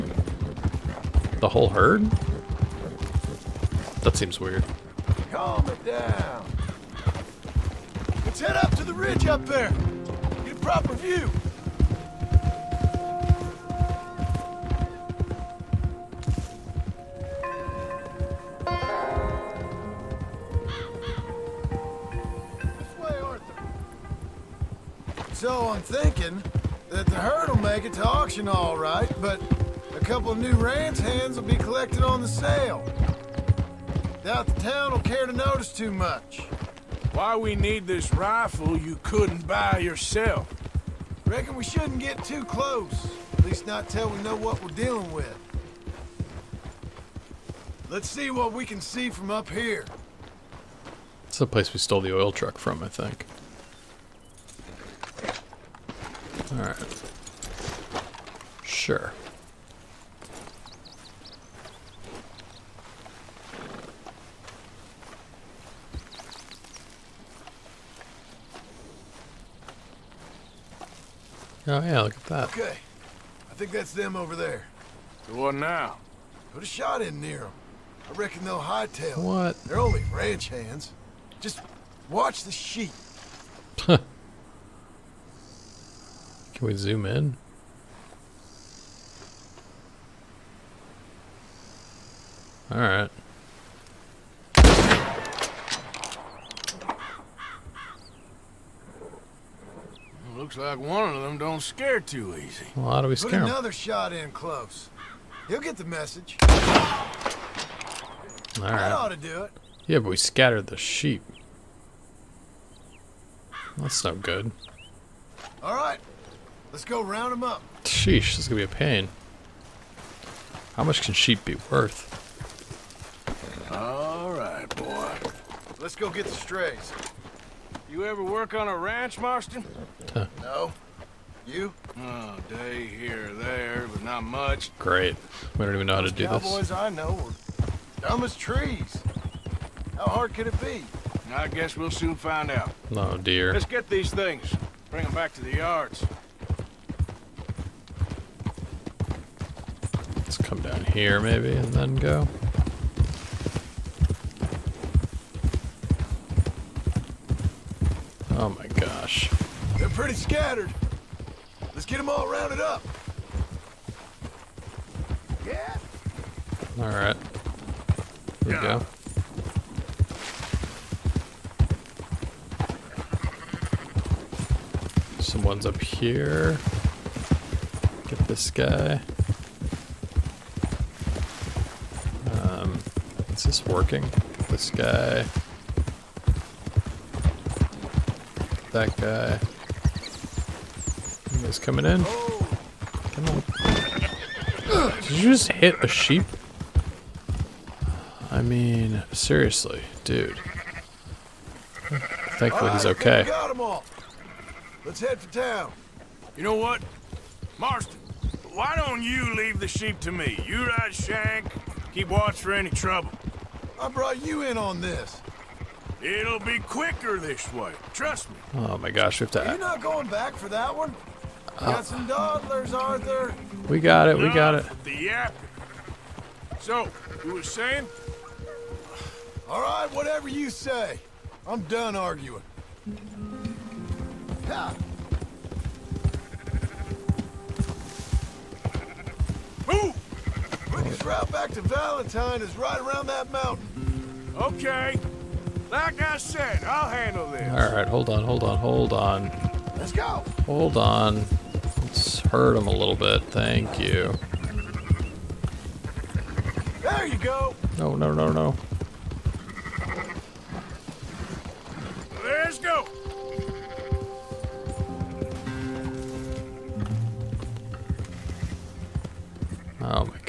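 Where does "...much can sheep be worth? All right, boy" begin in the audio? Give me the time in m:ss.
2:00.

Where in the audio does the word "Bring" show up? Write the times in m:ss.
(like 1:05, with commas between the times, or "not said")
2:24.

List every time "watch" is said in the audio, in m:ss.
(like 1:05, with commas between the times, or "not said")
1:22, 3:32.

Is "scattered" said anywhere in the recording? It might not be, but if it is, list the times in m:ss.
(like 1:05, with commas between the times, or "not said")
1:50, 2:40.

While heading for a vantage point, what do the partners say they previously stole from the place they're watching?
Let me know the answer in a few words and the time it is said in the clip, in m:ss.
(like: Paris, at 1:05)
oil truck, at 0:52.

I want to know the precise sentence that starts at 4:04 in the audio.
Okay, like I said, I'll handle this.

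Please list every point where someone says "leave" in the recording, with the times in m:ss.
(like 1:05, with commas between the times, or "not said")
3:29.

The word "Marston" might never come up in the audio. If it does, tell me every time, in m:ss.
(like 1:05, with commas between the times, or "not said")
2:09, 3:27.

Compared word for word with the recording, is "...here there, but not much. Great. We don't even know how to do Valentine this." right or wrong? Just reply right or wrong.
wrong.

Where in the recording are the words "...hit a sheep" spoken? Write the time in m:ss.
3:15.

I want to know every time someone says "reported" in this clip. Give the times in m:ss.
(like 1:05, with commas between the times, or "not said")
not said.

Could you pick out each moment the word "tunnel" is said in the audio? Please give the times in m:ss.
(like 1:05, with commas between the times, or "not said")
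not said.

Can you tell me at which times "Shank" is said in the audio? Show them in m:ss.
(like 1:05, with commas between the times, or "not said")
3:30.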